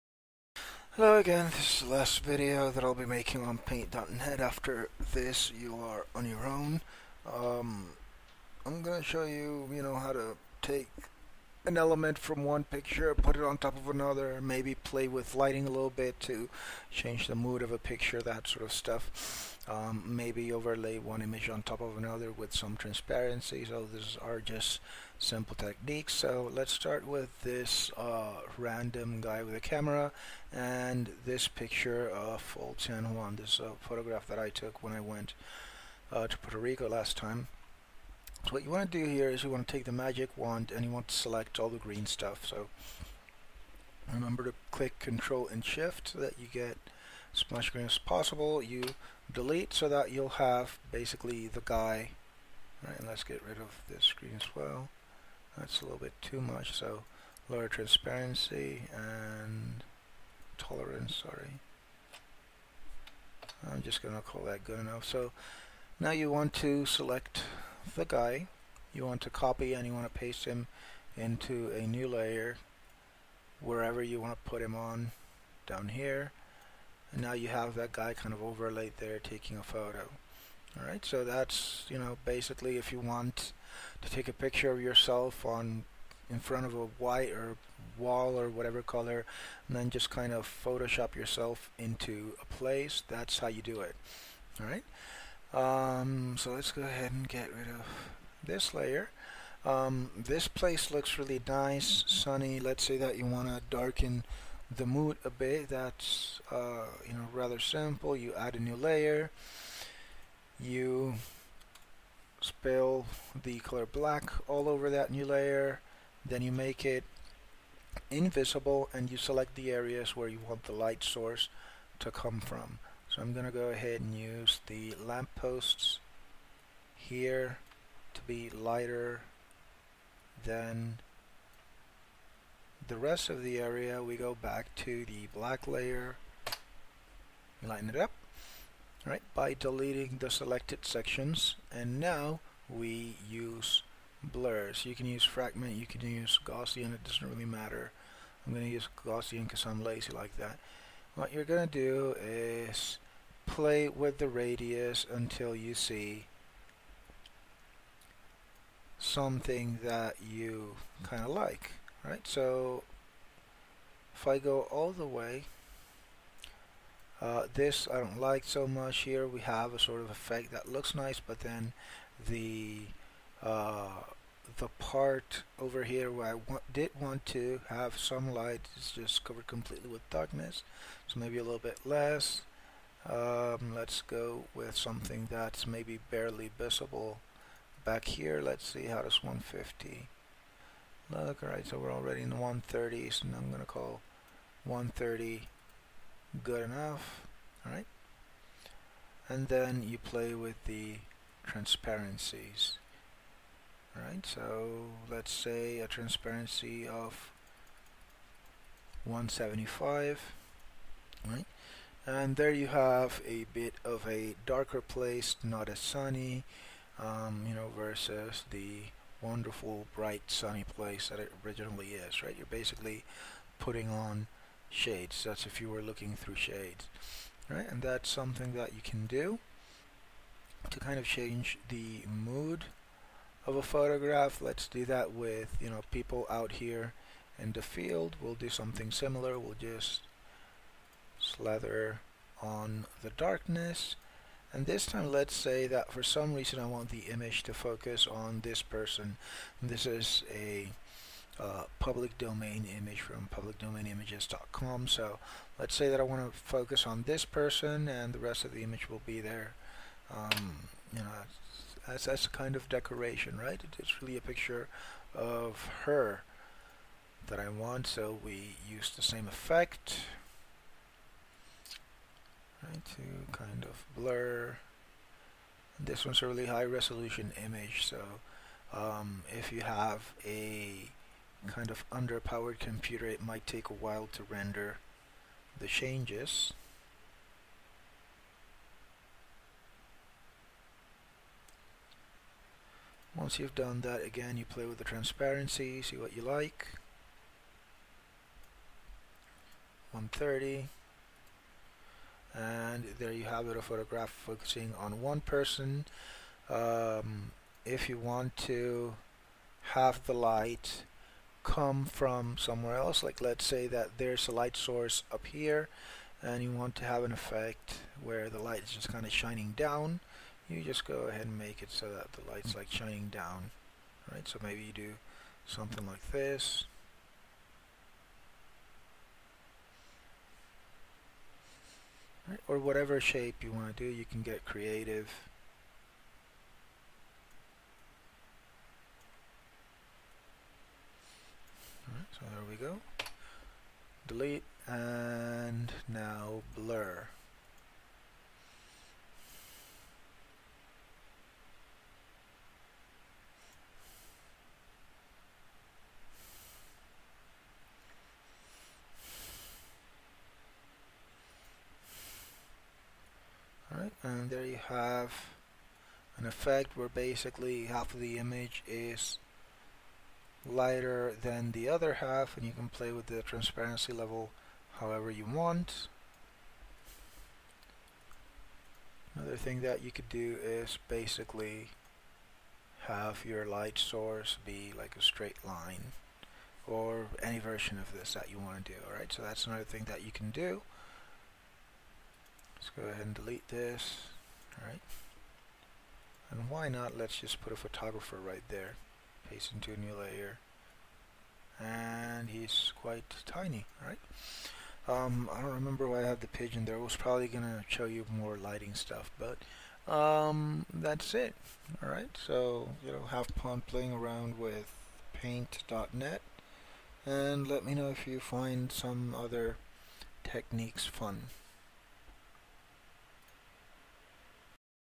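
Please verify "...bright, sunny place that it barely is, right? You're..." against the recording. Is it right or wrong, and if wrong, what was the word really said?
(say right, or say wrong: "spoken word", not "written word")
wrong: "originally", not "barely".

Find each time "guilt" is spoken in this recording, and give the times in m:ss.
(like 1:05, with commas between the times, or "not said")
not said.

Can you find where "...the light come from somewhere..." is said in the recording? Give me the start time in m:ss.
5:10.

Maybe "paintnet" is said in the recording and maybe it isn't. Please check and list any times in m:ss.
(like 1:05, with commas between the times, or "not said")
0:03, 6:55.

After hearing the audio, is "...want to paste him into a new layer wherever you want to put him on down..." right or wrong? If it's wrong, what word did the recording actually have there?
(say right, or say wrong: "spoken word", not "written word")
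right.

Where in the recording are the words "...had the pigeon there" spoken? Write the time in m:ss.
6:46.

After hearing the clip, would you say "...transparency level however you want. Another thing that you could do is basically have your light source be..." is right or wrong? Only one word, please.
right.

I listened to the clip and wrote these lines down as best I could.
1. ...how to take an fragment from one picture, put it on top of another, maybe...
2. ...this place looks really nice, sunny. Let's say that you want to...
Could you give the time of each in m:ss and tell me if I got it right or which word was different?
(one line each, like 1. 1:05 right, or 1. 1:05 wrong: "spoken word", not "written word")
1. 0:09 wrong: "element", not "fragment"
2. 1:40 right.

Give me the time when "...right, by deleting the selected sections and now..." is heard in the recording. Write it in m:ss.
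2:19.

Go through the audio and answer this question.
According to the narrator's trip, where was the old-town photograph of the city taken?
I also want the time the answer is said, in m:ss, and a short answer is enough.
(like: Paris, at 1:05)
Puerto Rico, at 0:36.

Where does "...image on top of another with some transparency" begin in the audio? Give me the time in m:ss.
0:21.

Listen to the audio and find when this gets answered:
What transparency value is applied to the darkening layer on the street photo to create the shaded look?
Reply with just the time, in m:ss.
3:29.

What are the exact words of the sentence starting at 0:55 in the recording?
That's a little bit too much.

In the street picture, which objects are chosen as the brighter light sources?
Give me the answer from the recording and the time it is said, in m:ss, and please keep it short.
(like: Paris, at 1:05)
Lampposts, at 2:05.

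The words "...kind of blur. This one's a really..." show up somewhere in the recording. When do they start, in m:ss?
4:33.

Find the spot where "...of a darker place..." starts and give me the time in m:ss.
3:33.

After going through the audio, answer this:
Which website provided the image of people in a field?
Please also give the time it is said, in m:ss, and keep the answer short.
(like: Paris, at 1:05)
publicdomainimages.com, at 4:13.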